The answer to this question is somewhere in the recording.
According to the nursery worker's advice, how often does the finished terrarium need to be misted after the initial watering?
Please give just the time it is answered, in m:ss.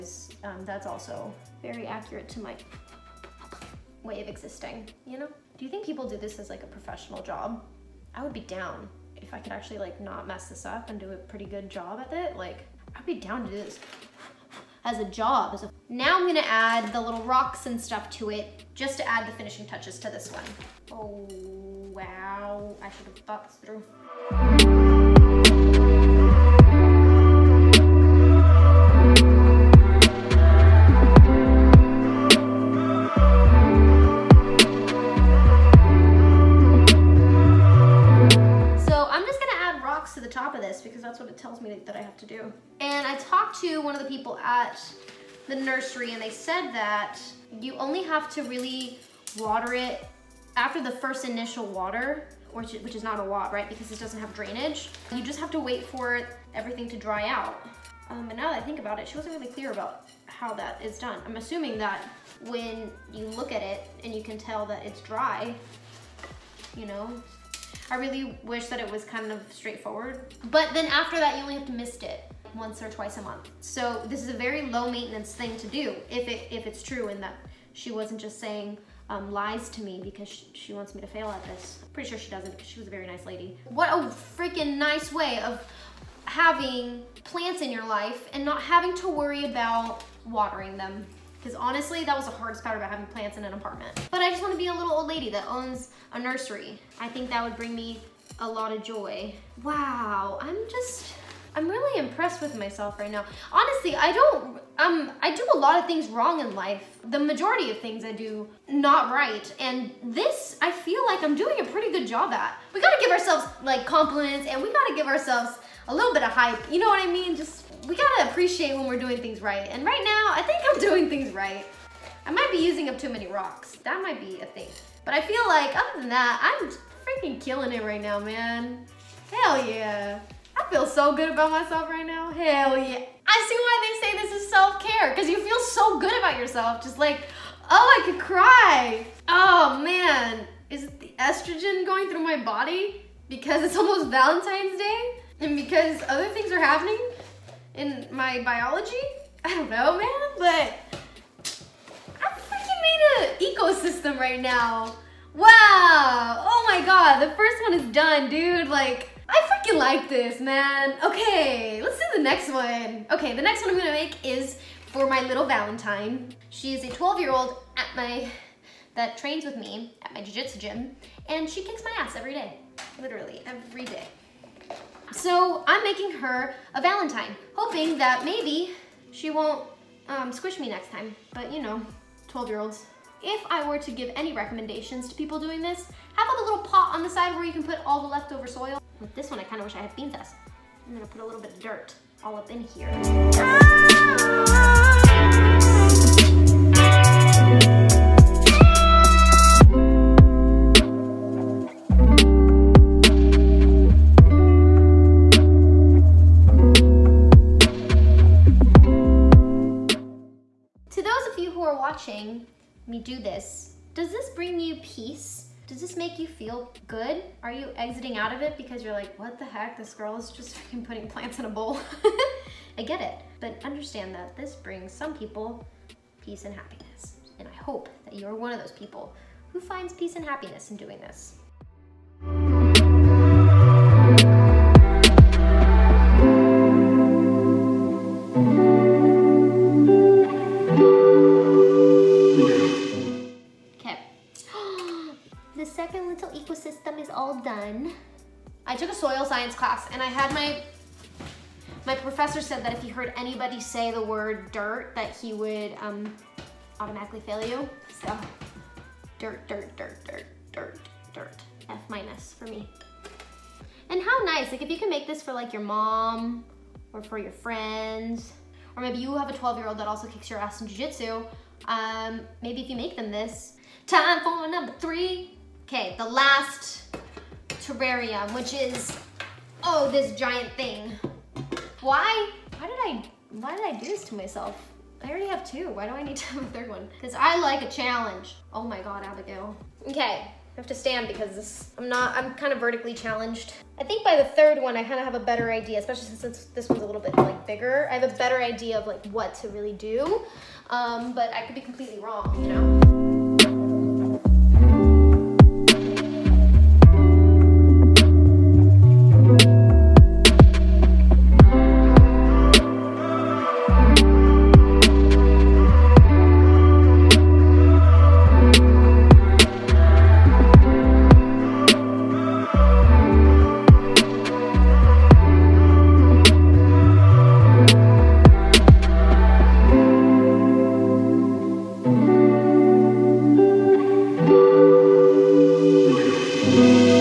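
1:12.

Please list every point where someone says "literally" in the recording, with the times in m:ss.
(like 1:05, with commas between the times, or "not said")
2:52.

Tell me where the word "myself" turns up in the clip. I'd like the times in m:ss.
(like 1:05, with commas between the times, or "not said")
1:42, 2:11, 4:44.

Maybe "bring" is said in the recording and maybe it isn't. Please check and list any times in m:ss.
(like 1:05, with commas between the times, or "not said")
1:37, 3:44.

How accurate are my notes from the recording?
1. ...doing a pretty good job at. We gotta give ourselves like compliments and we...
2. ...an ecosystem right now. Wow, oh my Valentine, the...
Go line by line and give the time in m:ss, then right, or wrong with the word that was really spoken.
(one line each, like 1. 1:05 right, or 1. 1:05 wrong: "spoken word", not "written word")
1. 1:51 right
2. 2:33 wrong: "God", not "Valentine".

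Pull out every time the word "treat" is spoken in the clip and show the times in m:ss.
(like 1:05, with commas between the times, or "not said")
not said.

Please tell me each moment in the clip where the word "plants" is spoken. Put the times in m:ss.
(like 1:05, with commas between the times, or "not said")
1:27, 1:33, 3:41.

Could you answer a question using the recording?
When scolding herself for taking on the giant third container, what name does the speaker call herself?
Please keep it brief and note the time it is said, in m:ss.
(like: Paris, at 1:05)
Abygail, at 4:49.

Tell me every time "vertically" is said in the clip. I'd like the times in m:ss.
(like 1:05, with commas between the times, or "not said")
4:52.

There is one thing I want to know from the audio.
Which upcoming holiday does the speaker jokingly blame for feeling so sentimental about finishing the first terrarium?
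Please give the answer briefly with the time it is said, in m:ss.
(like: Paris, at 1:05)
Valentine's Day, at 2:24.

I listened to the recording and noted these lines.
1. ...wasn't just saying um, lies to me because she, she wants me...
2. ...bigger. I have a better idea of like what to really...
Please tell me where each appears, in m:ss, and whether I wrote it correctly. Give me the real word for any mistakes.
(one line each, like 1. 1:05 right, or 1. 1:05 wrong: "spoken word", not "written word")
1. 1:17 right
2. 4:57 right.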